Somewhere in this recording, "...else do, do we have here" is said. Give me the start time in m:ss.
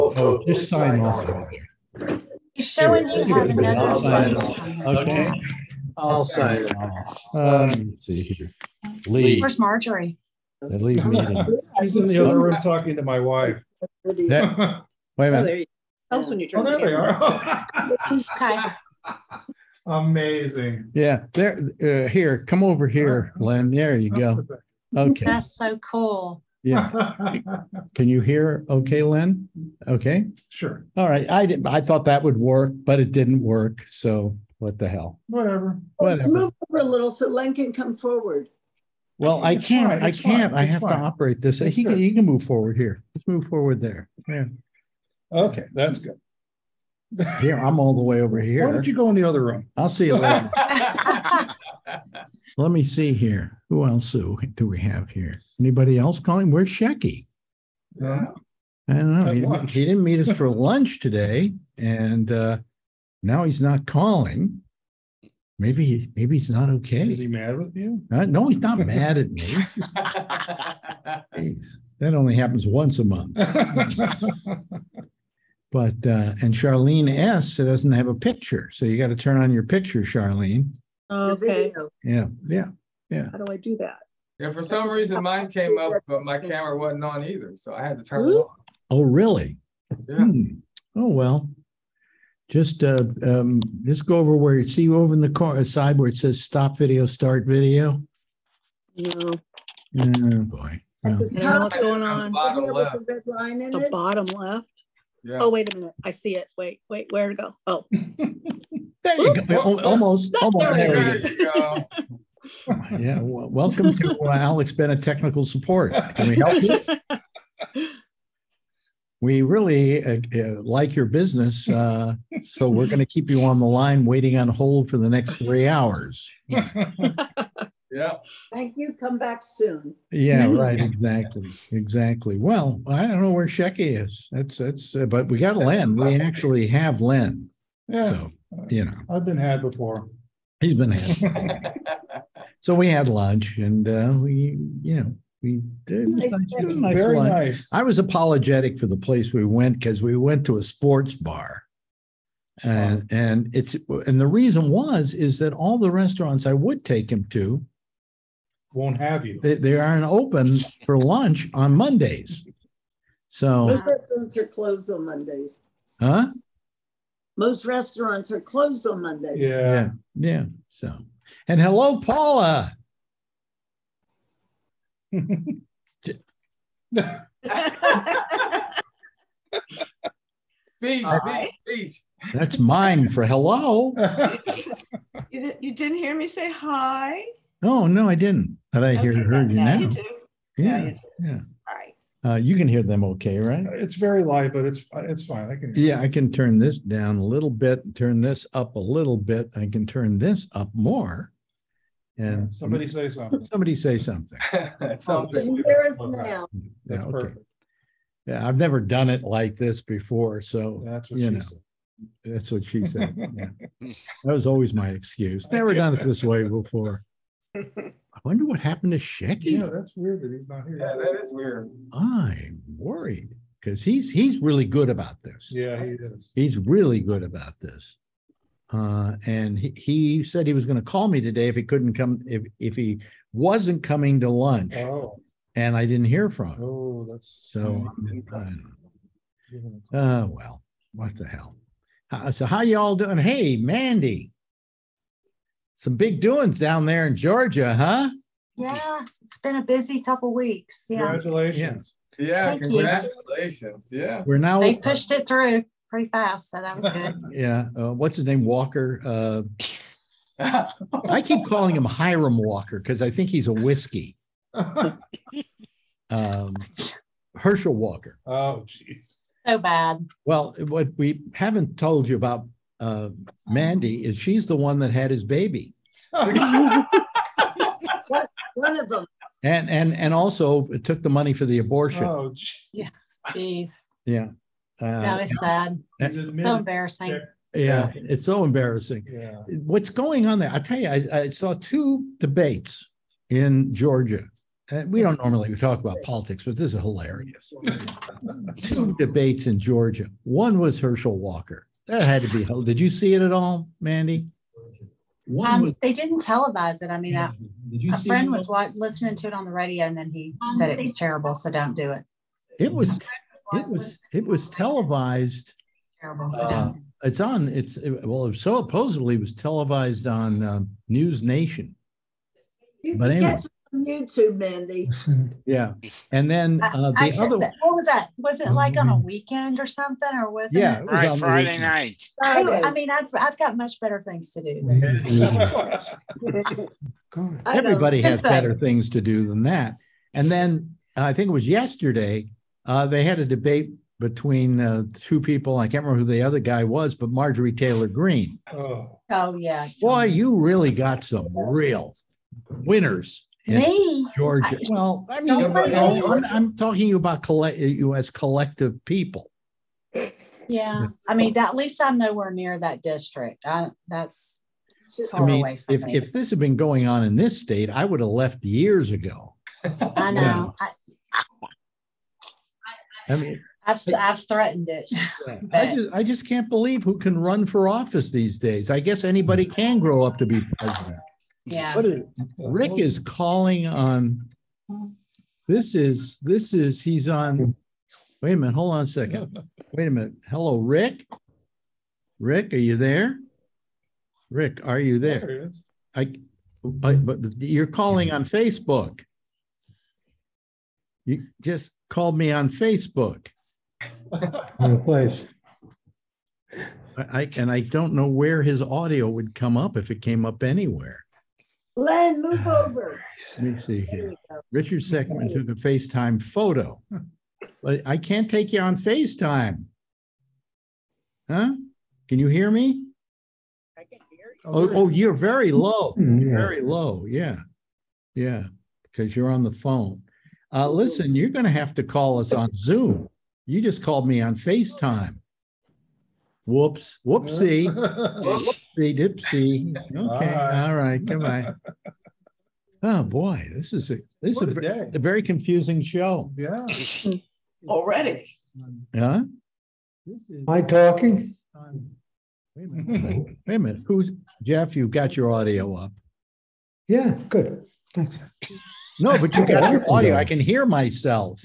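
0:53.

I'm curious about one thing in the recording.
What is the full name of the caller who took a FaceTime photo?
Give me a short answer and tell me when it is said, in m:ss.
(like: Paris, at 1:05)
Richard Sheckman, at 6:54.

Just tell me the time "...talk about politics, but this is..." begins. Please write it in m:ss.
4:55.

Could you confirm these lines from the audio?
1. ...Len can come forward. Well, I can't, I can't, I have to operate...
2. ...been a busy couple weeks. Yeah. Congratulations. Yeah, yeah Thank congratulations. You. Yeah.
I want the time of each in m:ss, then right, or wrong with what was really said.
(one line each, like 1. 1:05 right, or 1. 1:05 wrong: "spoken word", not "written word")
1. 0:37 right
2. 4:09 right.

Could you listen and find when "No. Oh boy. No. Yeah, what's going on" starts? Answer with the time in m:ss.
1:38.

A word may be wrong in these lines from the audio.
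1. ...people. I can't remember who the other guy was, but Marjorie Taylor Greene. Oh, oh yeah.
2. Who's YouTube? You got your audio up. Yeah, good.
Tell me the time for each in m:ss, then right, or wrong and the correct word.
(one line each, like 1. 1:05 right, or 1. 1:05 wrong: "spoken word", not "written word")
1. 5:45 right
2. 7:33 wrong: "Jeff", not "YouTube".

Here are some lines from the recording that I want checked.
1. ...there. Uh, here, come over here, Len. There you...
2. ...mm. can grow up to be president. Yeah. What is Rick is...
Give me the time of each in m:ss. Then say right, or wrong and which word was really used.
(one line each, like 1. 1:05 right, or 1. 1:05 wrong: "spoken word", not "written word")
1. 0:21 right
2. 6:19 right.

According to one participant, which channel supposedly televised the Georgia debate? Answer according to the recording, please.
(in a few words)
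News Nation.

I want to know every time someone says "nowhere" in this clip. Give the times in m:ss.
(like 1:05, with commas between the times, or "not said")
6:01.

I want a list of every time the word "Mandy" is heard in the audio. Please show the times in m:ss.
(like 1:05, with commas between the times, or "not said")
4:03, 4:33, 5:03, 5:24.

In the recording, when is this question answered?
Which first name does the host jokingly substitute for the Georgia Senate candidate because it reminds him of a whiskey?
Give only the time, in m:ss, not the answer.
4:21.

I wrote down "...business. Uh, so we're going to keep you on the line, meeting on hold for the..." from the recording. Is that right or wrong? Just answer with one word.
wrong.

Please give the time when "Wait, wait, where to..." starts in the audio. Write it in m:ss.
1:46.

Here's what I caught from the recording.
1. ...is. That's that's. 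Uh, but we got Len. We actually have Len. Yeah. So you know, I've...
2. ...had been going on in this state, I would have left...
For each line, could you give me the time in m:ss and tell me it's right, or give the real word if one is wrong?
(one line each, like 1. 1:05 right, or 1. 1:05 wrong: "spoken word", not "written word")
1. 2:14 right
2. 6:06 right.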